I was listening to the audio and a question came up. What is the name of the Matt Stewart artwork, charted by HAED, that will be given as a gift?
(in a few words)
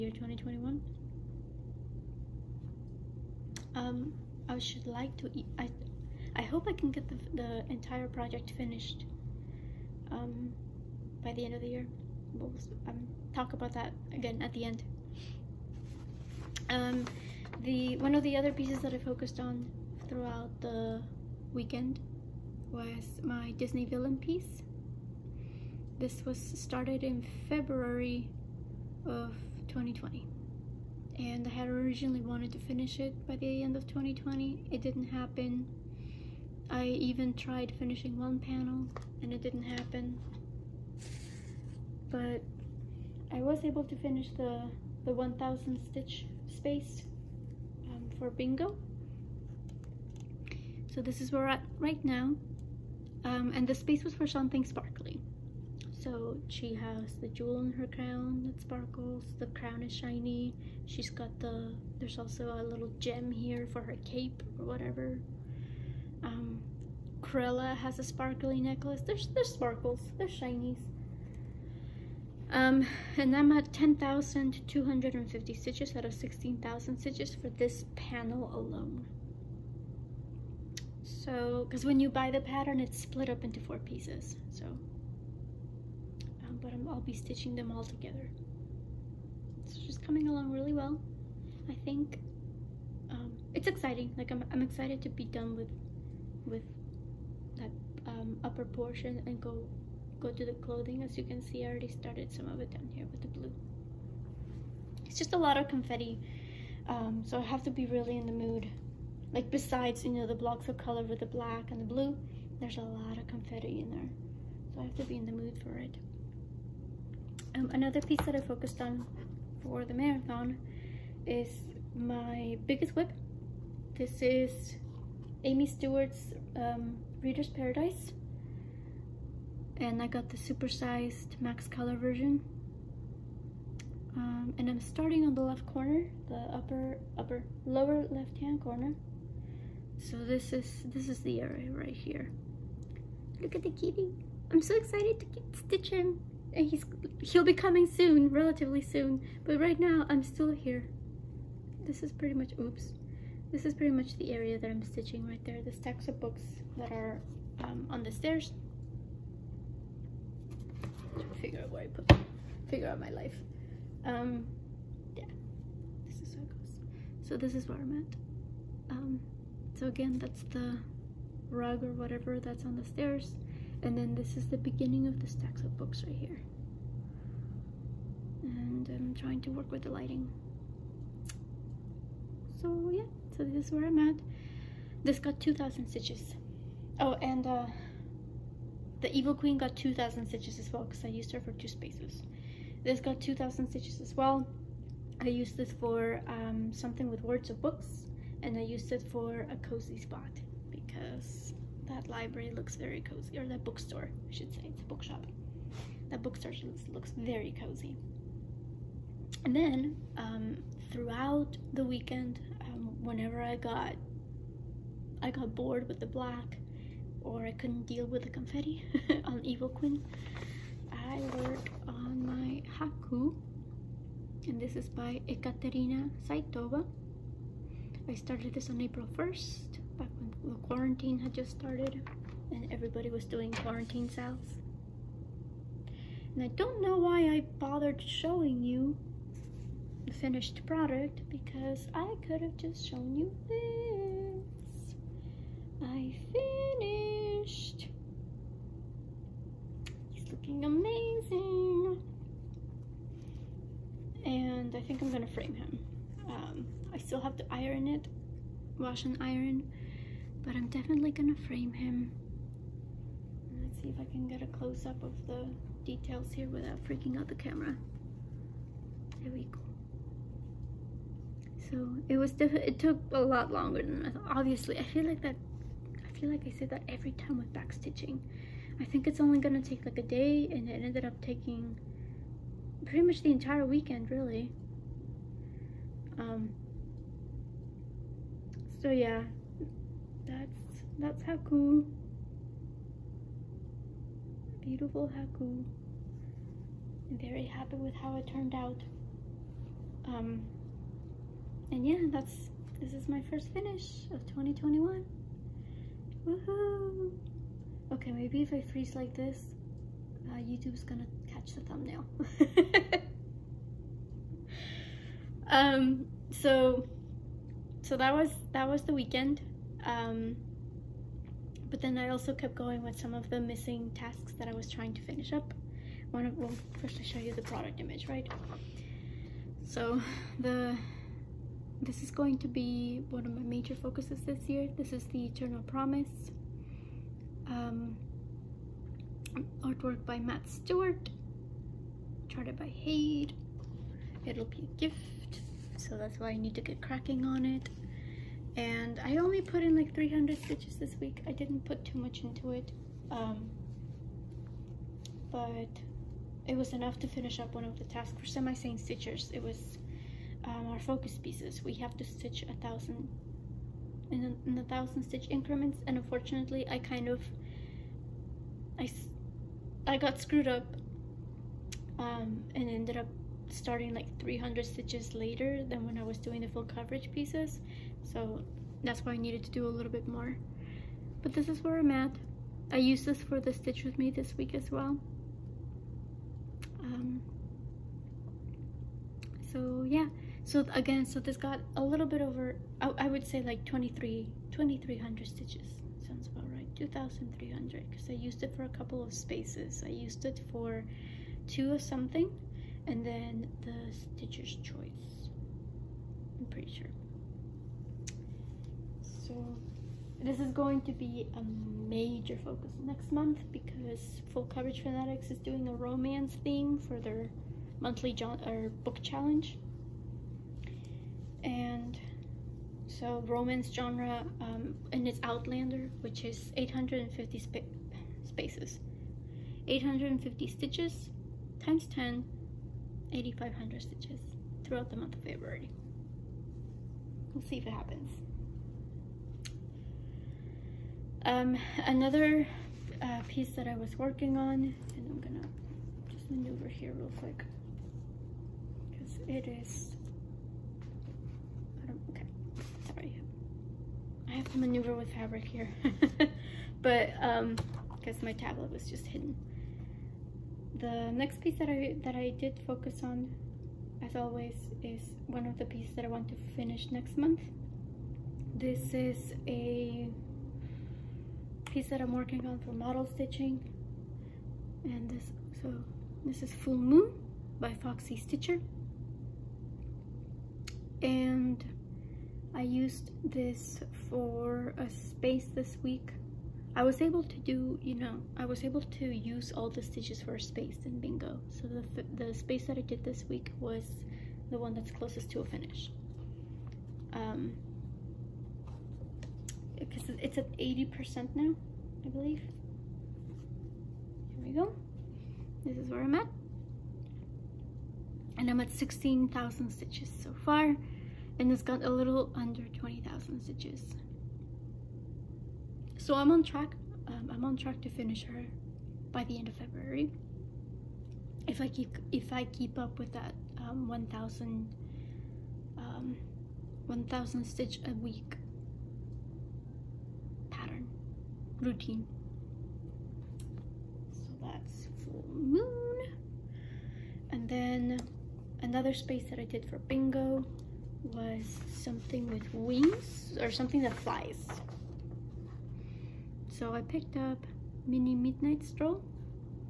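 Eternal Promise.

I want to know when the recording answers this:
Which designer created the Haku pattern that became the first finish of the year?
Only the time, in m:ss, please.
3:45.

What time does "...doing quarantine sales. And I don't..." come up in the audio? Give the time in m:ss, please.
3:53.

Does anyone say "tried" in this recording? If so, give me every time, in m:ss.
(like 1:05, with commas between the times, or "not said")
0:37.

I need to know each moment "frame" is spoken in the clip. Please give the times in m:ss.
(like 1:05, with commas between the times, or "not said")
4:15, 4:21.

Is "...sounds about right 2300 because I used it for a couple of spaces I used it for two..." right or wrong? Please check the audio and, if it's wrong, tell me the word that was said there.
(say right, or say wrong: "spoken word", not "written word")
right.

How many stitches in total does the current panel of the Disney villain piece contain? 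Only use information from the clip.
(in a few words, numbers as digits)
16,000.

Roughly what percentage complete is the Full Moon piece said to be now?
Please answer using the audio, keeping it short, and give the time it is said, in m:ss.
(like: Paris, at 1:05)
80%, at 8:20.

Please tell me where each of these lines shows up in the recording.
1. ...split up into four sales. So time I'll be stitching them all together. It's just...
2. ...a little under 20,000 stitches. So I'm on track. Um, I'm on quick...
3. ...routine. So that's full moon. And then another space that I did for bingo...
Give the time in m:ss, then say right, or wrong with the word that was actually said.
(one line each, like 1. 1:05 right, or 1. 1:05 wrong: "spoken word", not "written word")
1. 1:22 wrong: "pieces", not "sales"
2. 8:31 wrong: "track", not "quick"
3. 8:51 right.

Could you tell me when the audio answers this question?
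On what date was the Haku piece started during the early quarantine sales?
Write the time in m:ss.
3:48.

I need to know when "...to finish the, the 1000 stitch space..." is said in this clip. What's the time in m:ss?
0:43.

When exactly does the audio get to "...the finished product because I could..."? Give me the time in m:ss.
4:00.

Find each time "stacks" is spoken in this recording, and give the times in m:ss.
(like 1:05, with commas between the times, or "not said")
2:35, 2:55.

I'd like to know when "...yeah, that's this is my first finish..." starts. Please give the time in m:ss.
5:01.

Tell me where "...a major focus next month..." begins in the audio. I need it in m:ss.
6:51.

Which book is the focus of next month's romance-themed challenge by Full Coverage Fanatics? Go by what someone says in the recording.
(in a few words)
Outlander.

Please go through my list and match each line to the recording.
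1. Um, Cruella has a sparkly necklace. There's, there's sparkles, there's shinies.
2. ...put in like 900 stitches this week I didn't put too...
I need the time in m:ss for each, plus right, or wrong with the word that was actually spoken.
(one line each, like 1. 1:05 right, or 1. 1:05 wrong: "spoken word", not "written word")
1. 1:06 right
2. 5:49 wrong: "300", not "900".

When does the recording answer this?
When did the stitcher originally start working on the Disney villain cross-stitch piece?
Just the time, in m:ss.
0:27.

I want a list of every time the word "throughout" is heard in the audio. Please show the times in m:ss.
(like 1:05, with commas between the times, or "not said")
0:20, 3:30, 7:14.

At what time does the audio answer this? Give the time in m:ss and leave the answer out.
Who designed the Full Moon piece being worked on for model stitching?
7:57.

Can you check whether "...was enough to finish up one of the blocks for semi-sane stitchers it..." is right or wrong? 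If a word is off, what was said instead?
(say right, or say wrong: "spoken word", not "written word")
wrong: "tasks", not "blocks".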